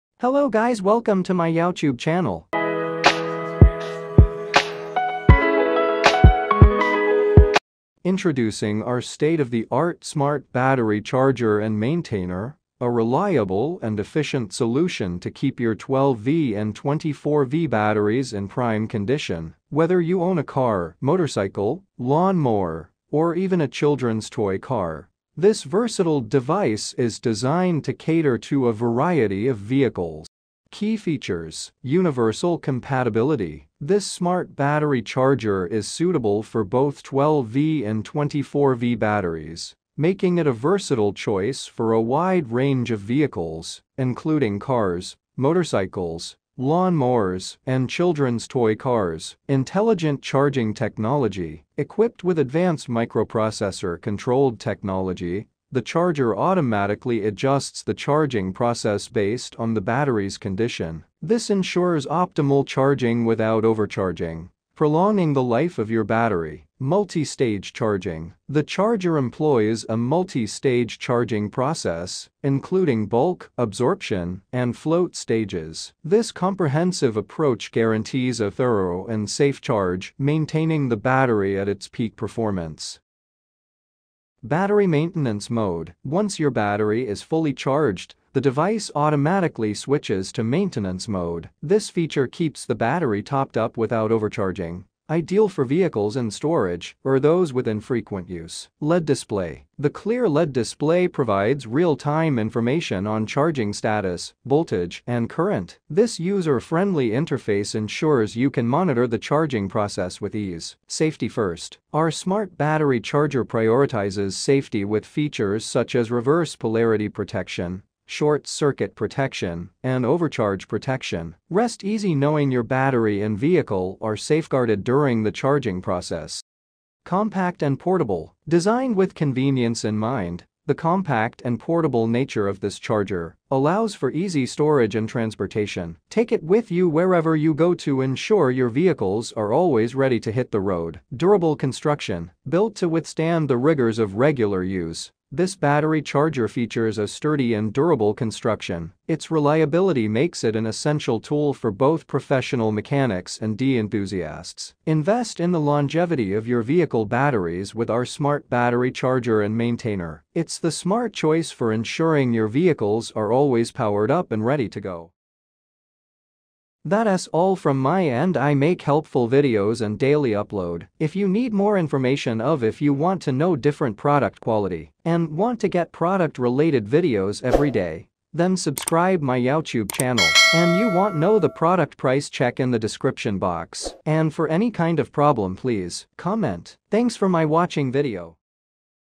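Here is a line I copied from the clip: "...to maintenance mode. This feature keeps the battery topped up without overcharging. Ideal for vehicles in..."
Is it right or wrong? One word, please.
right.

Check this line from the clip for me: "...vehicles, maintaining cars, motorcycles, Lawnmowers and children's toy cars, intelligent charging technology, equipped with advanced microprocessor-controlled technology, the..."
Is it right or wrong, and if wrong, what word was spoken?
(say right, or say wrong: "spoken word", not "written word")
wrong: "including", not "maintaining".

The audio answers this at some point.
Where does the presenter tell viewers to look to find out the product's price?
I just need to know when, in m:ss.
3:02.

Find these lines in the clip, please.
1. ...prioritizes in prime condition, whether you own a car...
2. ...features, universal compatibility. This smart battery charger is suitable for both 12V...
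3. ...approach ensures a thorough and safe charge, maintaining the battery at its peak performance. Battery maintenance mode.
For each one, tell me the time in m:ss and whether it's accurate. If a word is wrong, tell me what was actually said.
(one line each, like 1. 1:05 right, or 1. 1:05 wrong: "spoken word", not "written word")
1. 0:17 wrong: "batteries", not "prioritizes"
2. 0:30 right
3. 1:17 wrong: "guarantees", not "ensures".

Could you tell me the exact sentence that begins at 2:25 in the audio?
This battery charger features a sturdy and durable construction.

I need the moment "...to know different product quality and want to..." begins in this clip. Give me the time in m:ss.
2:53.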